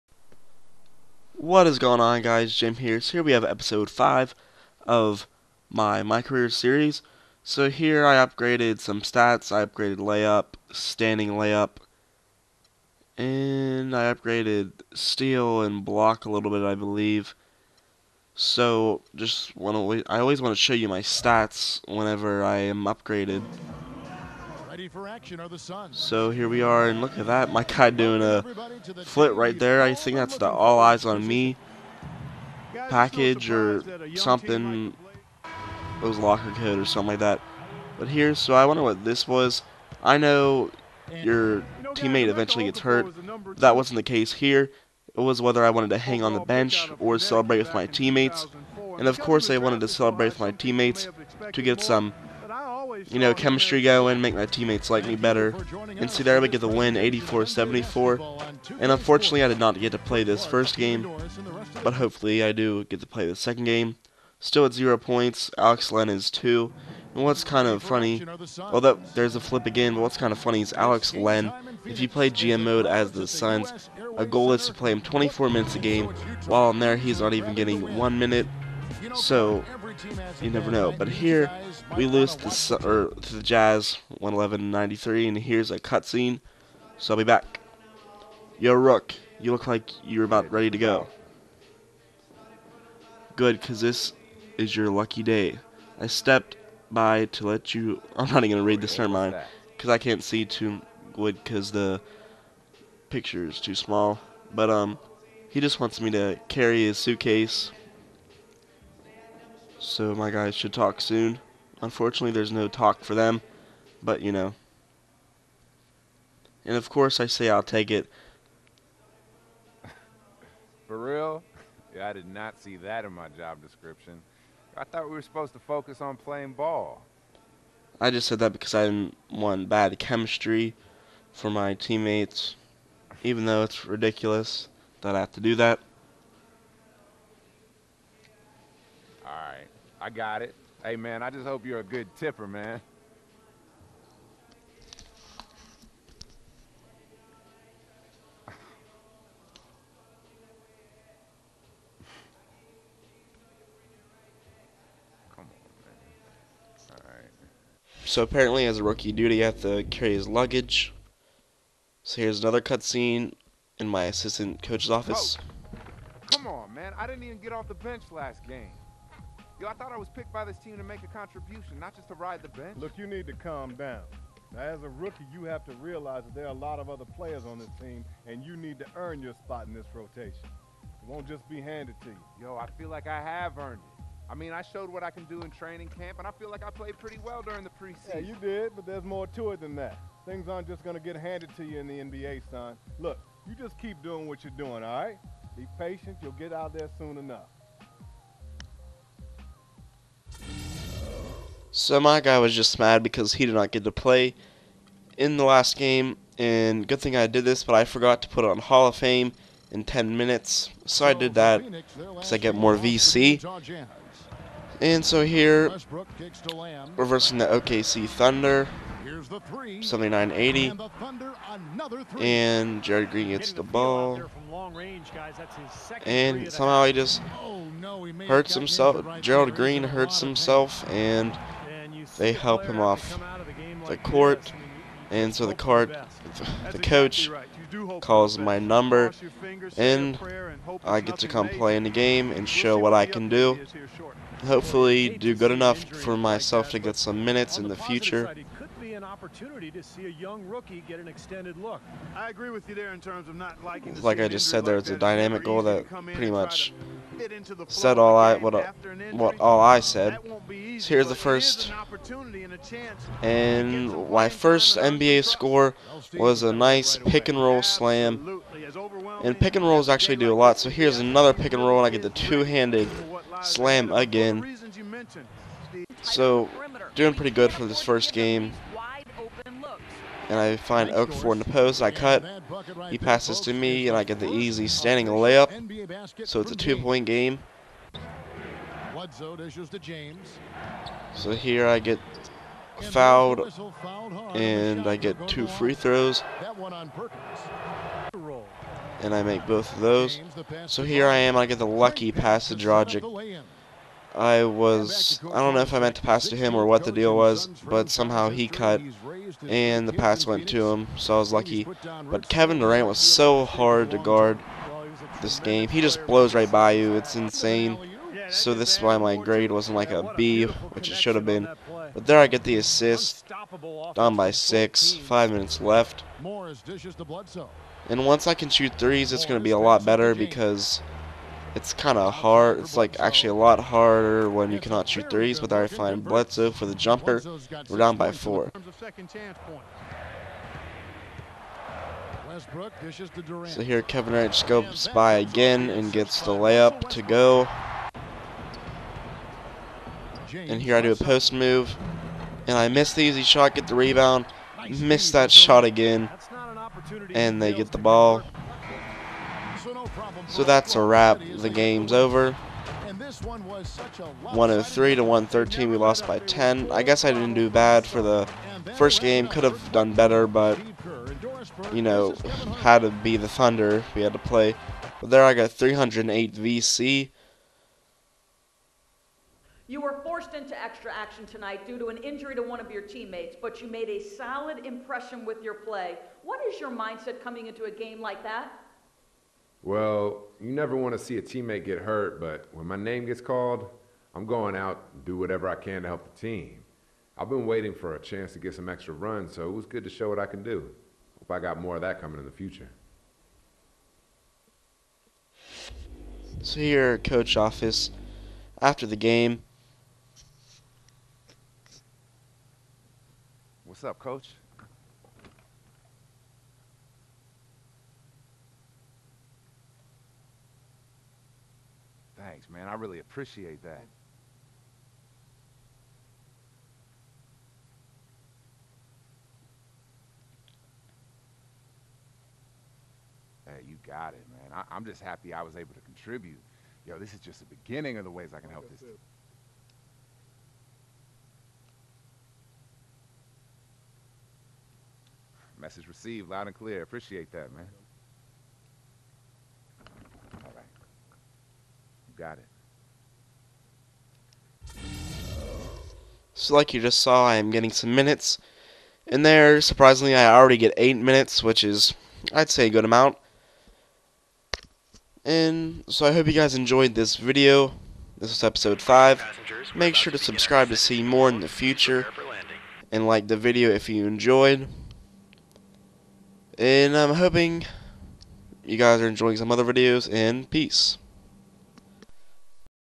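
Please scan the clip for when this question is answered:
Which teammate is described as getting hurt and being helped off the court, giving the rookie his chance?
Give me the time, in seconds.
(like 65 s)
229 s.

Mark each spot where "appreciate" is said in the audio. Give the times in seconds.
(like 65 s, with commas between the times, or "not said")
422 s, 446 s.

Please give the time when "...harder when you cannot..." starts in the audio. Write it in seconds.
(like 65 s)
333 s.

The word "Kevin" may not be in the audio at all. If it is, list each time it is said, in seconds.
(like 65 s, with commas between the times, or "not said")
312 s, 343 s.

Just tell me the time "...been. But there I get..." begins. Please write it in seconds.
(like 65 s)
321 s.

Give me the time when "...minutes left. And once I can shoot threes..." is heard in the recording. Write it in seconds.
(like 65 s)
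325 s.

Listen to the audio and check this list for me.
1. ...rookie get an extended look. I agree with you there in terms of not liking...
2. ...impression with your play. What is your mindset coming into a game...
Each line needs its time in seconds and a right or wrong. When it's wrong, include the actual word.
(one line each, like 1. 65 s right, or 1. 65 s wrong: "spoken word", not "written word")
1. 250 s right
2. 384 s right.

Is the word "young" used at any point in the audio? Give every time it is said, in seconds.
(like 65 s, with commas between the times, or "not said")
250 s.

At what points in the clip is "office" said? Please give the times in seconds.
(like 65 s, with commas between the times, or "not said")
164 s, 407 s.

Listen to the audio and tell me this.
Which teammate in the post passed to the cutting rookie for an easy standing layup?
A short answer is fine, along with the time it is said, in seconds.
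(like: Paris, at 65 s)
Okafor, at 280 s.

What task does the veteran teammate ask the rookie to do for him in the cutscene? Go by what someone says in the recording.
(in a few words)
Carry his suitcase.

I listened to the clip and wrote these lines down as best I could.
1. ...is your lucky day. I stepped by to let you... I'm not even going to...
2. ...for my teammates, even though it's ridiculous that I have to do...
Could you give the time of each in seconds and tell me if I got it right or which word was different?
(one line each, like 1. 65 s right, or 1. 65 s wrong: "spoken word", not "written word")
1. 94 s right
2. 131 s right.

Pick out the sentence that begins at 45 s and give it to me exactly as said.
It was whether I wanted to hang on the bench or celebrate with my teammates.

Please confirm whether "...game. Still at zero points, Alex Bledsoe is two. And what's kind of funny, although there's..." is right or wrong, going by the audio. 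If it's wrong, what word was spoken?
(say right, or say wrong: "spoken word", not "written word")
wrong: "Len", not "Bledsoe".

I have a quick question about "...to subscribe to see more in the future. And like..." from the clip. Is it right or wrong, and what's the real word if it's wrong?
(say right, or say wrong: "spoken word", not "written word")
right.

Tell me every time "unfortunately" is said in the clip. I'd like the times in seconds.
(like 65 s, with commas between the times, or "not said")
58 s, 111 s.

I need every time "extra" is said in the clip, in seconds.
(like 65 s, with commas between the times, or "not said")
380 s, 398 s.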